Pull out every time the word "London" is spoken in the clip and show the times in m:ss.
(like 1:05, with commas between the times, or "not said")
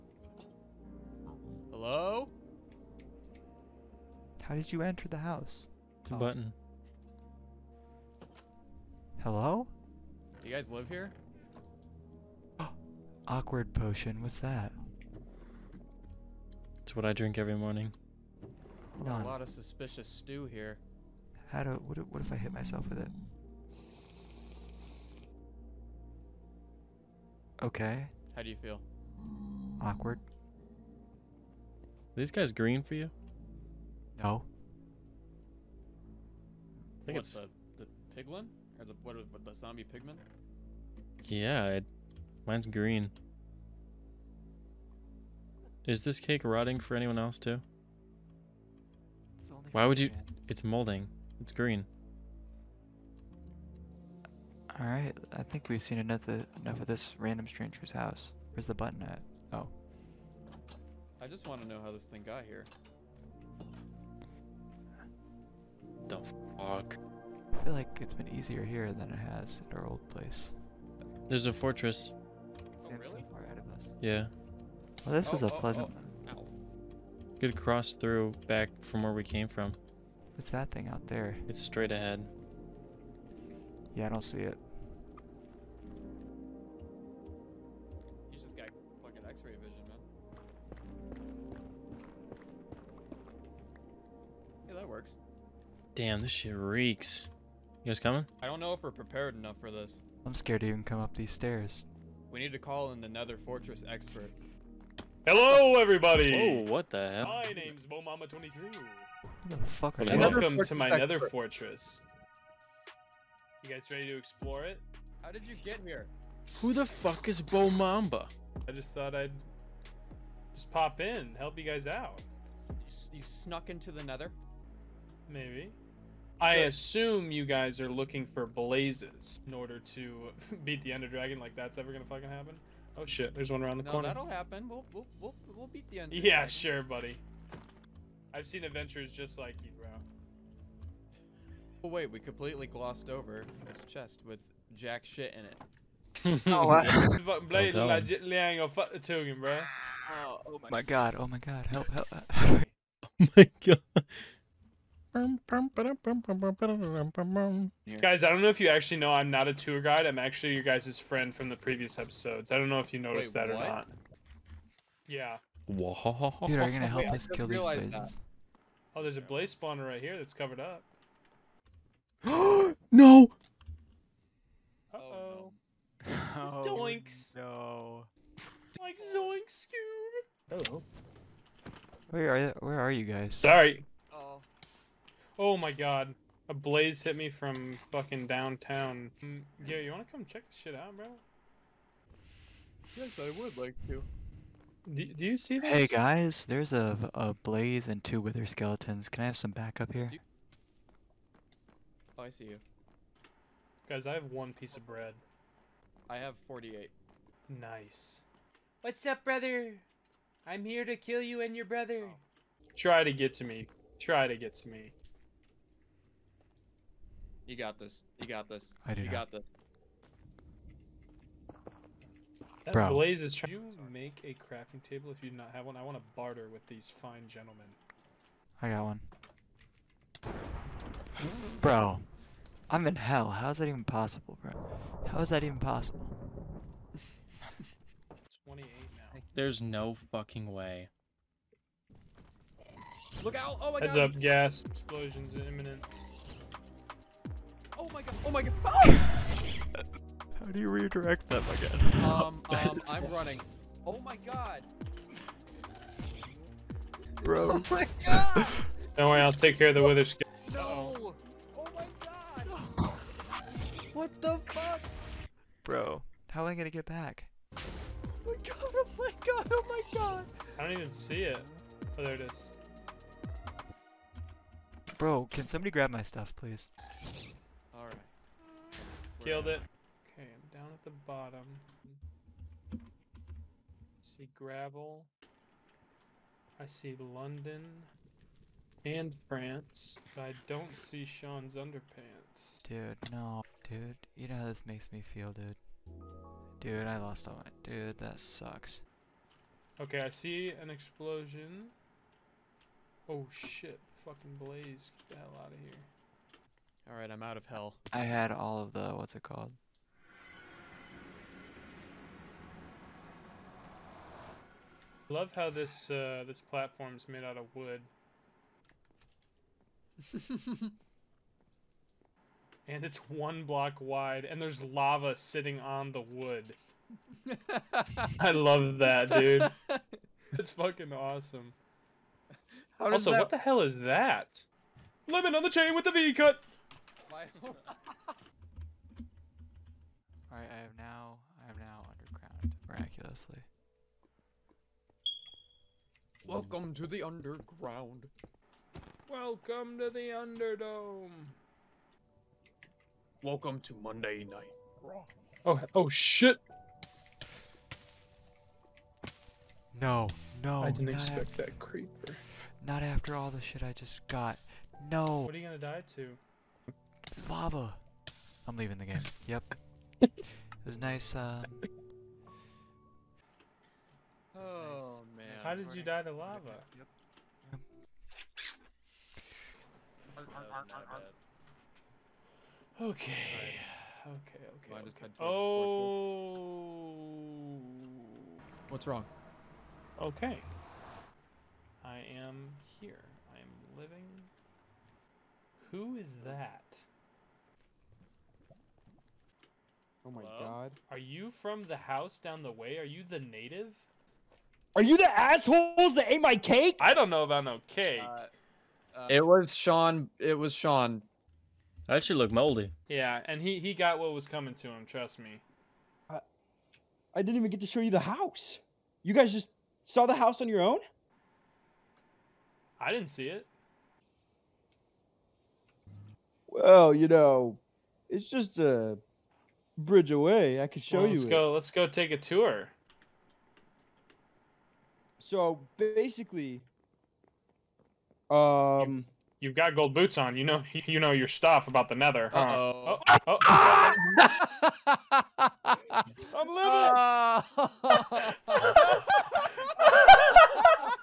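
4:46.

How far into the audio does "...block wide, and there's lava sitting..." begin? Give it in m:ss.
5:23.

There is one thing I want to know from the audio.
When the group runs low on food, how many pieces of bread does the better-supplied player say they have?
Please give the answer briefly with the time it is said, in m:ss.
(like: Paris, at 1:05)
48, at 3:26.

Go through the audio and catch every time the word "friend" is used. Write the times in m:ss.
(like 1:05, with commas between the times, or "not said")
2:40.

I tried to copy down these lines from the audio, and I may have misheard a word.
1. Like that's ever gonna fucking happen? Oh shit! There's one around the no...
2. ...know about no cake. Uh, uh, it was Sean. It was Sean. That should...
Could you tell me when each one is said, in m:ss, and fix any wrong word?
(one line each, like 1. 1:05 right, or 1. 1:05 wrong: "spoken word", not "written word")
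1. 2:11 right
2. 6:47 right.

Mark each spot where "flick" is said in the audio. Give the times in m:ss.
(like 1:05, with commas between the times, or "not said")
not said.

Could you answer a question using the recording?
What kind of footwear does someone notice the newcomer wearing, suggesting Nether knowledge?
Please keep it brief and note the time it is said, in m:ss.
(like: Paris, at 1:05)
Gold boots, at 7:19.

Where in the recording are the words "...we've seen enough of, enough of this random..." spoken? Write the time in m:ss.
0:55.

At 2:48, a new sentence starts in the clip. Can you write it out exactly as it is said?
Oh, there's a blaze spawner right here that's covered up.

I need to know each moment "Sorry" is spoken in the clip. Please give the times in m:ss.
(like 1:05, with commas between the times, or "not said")
3:03.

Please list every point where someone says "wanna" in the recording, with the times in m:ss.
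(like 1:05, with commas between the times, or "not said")
3:09.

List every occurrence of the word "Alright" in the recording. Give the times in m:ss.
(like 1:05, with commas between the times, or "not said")
5:06, 5:37.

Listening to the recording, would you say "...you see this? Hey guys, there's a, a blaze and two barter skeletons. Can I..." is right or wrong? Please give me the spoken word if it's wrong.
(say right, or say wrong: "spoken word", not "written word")
wrong: "wither", not "barter".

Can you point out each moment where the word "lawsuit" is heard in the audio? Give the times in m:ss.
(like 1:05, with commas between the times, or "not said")
not said.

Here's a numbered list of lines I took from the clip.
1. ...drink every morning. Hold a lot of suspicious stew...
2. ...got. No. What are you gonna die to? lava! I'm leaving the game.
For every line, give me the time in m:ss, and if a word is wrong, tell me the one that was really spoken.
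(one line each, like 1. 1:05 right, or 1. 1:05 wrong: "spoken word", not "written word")
1. 0:17 right
2. 6:04 right.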